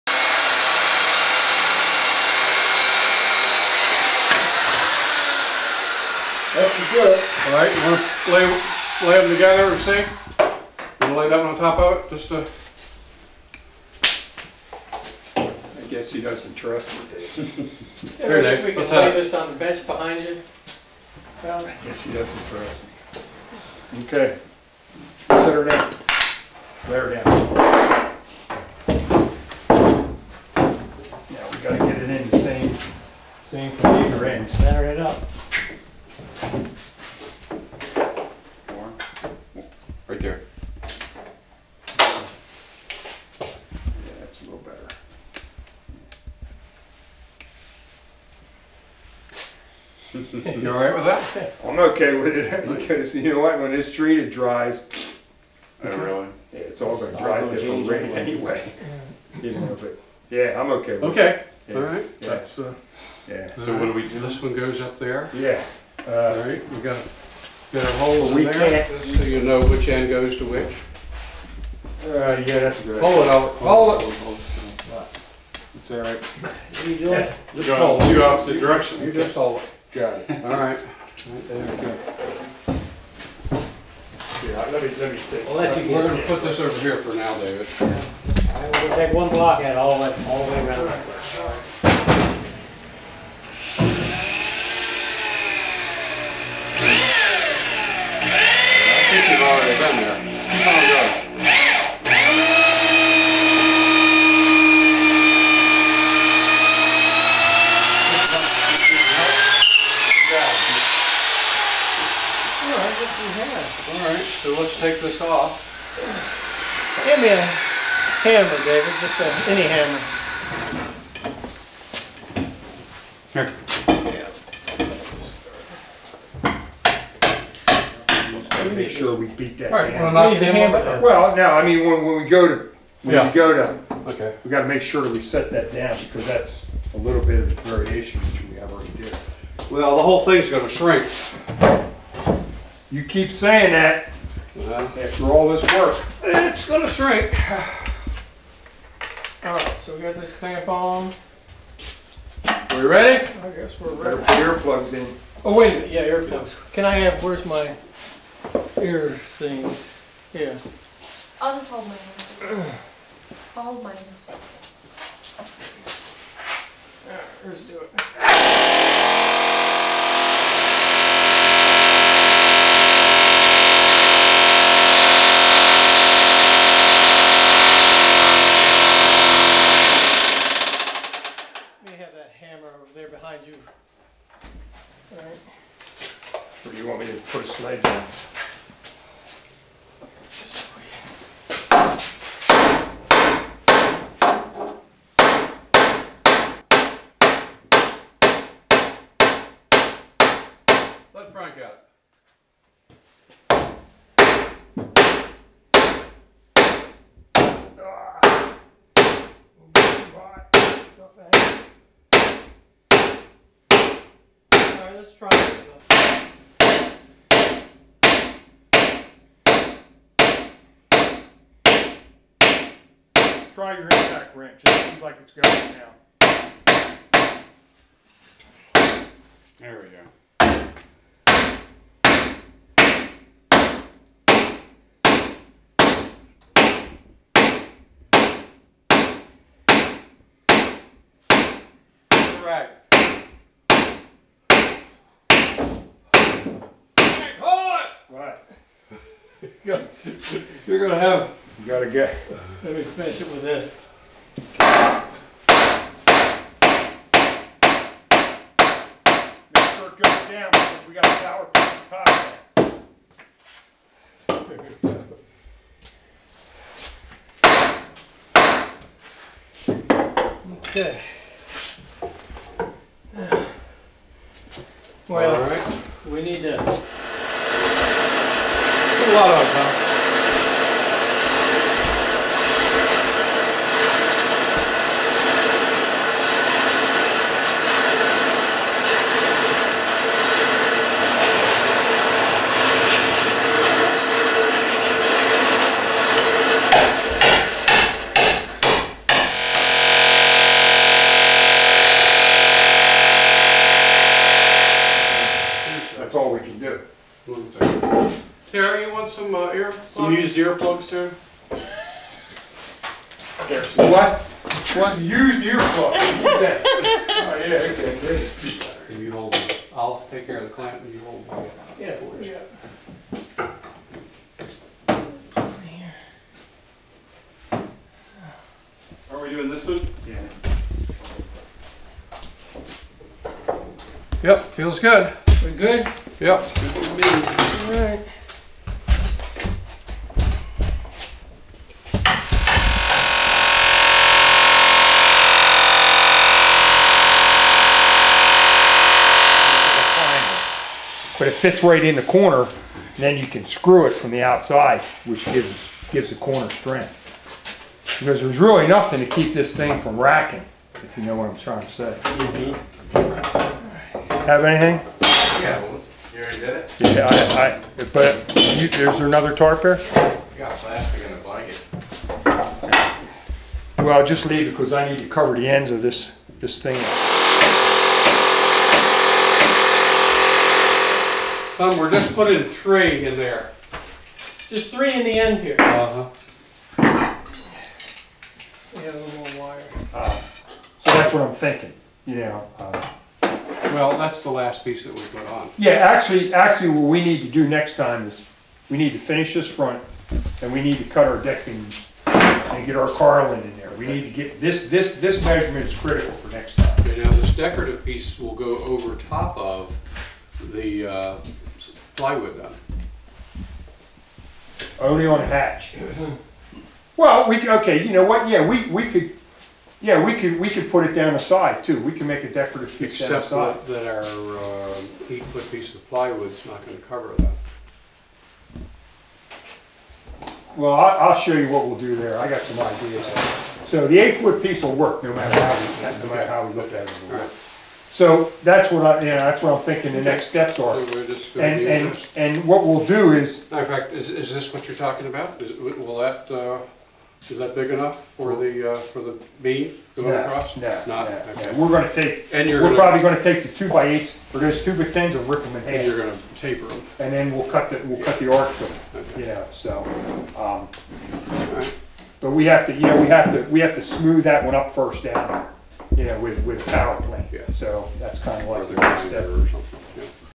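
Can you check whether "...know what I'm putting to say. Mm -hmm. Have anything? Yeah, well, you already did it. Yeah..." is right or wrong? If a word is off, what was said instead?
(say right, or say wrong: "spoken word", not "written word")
wrong: "trying", not "putting".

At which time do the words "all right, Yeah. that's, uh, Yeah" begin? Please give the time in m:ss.
1:01.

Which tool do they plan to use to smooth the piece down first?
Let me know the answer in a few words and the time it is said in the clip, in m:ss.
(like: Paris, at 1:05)
power plane, at 7:46.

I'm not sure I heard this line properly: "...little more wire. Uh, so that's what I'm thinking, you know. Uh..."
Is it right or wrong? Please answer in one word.
right.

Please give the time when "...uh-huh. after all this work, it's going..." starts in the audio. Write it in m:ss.
2:24.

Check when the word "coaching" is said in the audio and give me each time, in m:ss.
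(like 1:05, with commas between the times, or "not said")
not said.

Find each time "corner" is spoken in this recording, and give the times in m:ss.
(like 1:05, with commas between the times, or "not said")
5:52, 5:56.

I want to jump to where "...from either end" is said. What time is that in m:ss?
0:33.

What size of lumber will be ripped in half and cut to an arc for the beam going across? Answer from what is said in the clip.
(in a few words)
2x10s.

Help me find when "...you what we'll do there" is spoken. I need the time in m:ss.
7:11.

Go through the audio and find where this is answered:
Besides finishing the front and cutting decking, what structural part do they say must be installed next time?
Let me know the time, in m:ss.
6:42.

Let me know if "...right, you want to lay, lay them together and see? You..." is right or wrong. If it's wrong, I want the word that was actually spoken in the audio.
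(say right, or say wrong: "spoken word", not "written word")
right.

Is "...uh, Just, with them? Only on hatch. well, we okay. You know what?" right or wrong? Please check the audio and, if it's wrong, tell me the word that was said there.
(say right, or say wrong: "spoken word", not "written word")
wrong: "Plywood", not "Just".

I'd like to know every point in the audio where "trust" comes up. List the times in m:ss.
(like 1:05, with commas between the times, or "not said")
0:16, 0:22.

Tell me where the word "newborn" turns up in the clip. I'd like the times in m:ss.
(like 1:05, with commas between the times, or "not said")
not said.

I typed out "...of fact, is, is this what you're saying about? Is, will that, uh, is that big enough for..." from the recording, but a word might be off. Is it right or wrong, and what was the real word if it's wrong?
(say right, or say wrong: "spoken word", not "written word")
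wrong: "talking", not "saying".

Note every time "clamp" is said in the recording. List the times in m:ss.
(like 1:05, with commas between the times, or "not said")
2:30, 5:20.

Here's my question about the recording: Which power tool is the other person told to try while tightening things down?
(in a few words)
impact wrench.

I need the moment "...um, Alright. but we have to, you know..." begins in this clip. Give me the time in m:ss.
7:40.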